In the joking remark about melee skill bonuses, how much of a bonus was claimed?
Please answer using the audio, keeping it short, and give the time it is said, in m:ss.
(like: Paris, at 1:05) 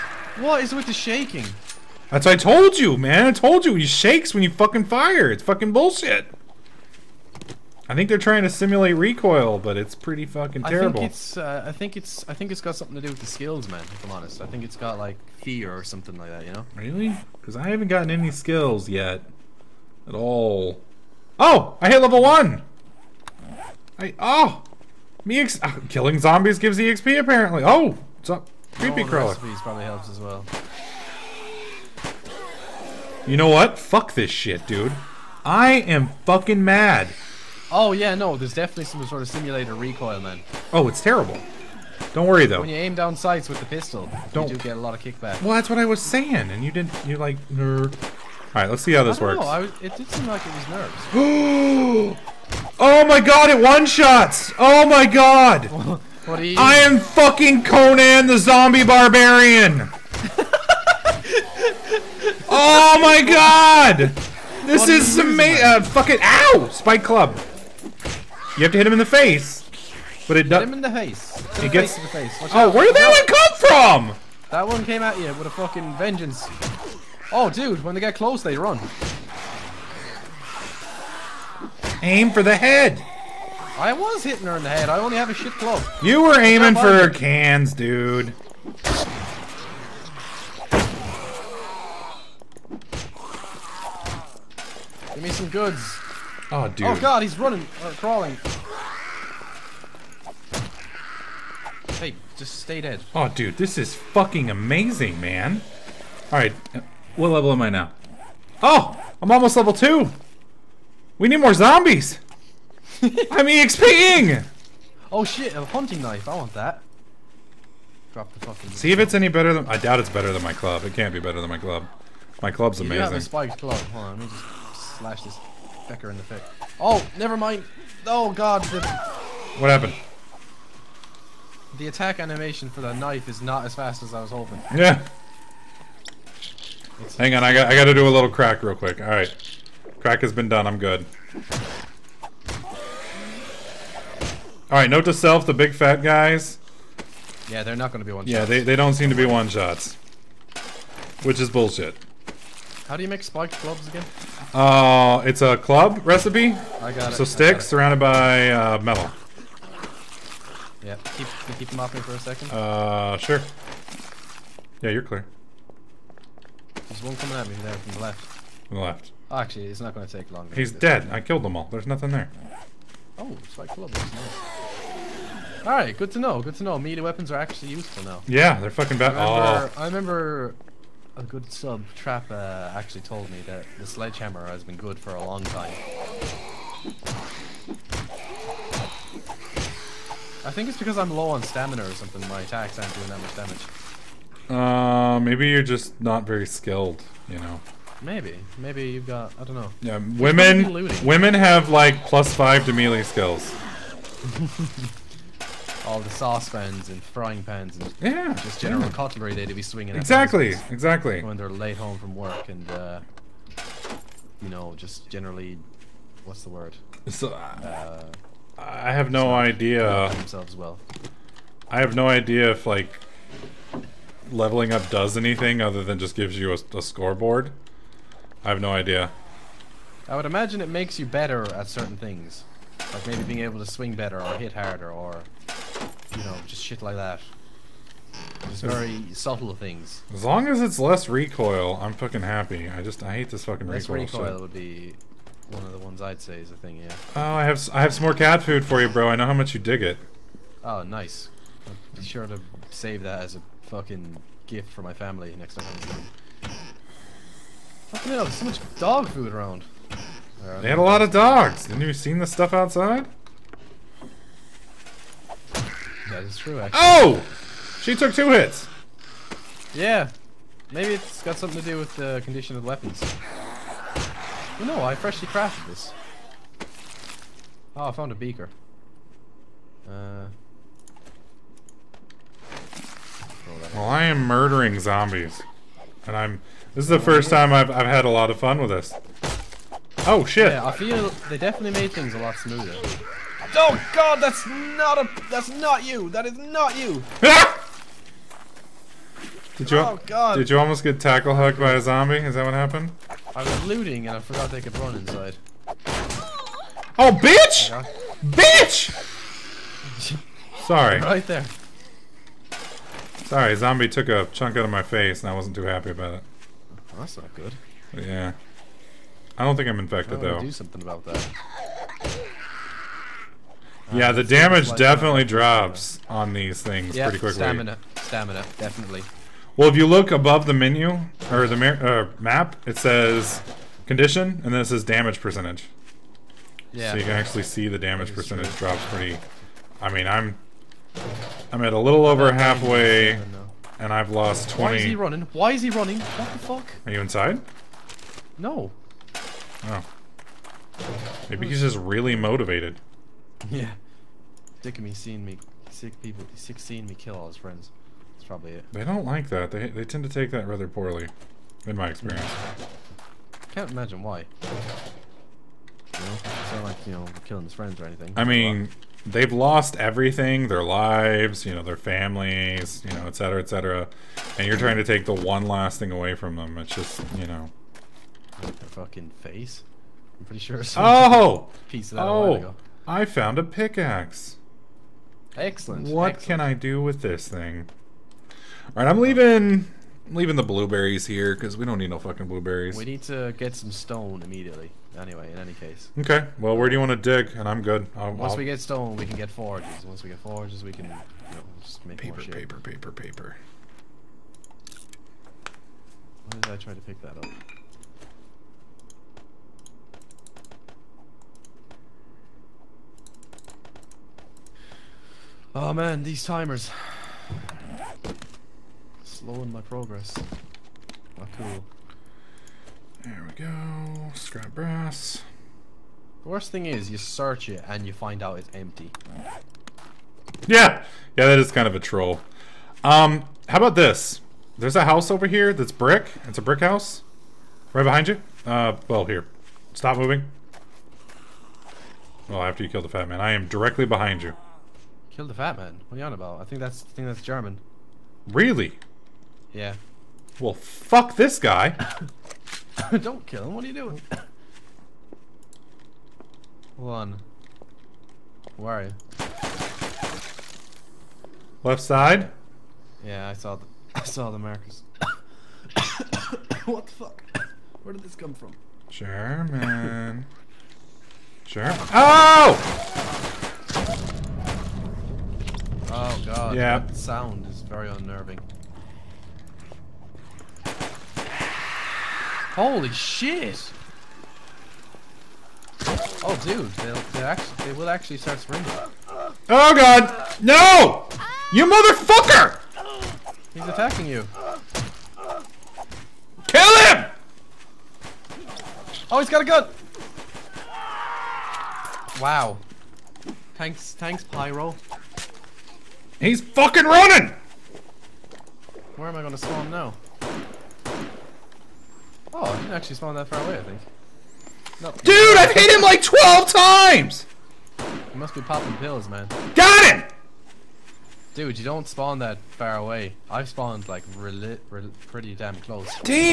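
Plus 5, at 3:22.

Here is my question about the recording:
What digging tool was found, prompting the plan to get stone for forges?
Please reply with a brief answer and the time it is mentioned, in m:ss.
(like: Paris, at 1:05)
Pickaxe, at 6:23.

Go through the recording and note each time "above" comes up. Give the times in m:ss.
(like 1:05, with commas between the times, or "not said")
5:30.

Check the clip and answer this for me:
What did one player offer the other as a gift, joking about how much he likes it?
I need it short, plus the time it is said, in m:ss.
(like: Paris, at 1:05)
Cat food, at 4:08.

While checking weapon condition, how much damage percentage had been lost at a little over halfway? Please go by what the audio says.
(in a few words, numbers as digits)
20.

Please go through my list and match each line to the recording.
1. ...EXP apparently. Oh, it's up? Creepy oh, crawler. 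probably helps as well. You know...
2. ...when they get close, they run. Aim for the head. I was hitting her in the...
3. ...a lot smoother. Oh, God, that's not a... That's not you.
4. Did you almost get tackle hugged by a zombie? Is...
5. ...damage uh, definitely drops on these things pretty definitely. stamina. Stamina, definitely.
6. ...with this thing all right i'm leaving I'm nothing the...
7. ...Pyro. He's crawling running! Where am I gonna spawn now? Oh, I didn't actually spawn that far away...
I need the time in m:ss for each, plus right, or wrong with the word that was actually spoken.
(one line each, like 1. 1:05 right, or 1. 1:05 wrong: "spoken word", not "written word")
1. 0:26 right
2. 1:17 right
3. 4:52 right
4. 5:00 right
5. 5:24 wrong: "quickly", not "definitely"
6. 6:26 wrong: "leaving", not "nothing"
7. 8:24 wrong: "fucking", not "crawling".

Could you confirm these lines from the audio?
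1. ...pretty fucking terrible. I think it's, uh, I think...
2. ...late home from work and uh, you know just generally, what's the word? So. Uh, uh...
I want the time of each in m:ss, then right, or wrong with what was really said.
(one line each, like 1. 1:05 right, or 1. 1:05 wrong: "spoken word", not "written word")
1. 0:09 right
2. 3:31 right.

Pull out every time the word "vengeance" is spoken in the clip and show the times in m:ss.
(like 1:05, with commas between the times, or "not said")
1:15.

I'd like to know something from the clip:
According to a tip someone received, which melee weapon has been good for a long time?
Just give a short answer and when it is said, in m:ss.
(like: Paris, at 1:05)
Sledgehammer, at 3:03.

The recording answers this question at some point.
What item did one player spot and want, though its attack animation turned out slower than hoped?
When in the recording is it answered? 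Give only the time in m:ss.
1:55.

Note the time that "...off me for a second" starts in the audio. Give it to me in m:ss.
2:41.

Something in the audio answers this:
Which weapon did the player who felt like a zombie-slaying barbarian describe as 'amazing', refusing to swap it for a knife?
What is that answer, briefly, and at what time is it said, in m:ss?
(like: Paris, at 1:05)
Spiked club, at 1:06.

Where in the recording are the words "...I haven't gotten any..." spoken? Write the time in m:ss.
0:17.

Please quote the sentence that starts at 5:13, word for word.
Sorry, zombie took a chunk out of my face and I wasn't too happy about it.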